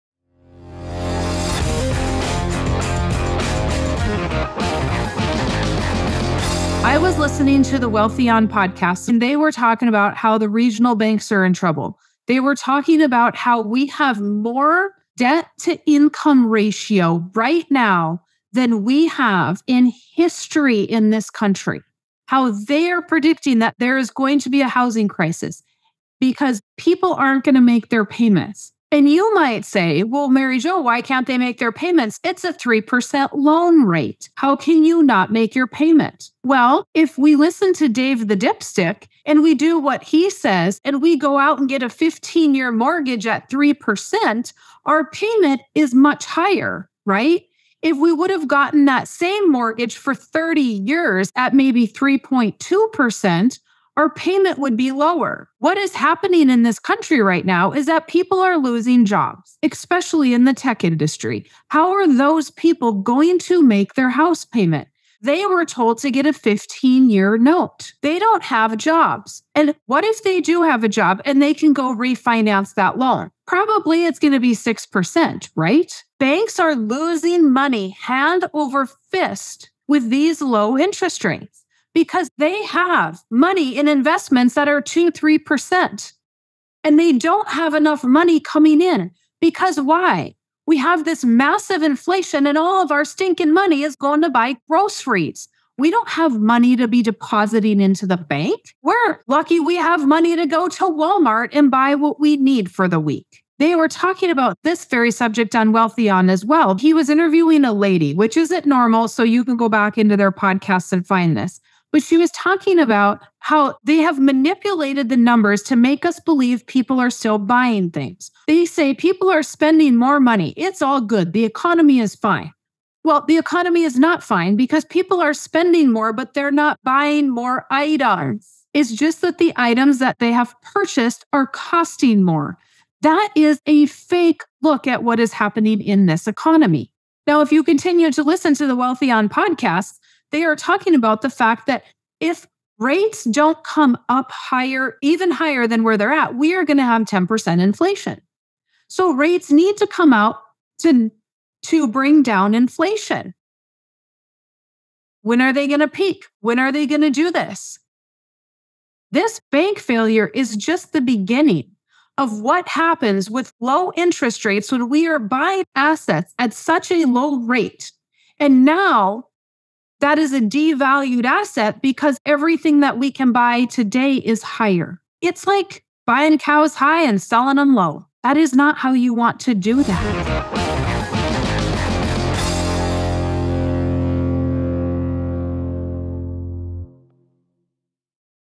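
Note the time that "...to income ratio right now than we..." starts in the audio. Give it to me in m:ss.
0:15.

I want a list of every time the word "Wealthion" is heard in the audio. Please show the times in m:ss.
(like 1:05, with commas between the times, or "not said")
0:07, 1:45, 2:18.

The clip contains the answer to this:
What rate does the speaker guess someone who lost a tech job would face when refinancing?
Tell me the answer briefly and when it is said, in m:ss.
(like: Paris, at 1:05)
6%, at 1:14.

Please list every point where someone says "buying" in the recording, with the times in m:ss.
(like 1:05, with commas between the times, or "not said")
1:57, 2:06, 2:45, 2:56.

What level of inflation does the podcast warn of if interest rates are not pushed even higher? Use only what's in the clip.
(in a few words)
10%.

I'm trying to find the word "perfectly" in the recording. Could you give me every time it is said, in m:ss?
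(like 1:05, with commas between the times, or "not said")
not said.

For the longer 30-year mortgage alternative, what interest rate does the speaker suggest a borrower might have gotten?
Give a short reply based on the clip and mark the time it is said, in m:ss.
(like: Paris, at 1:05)
3.2%, at 0:51.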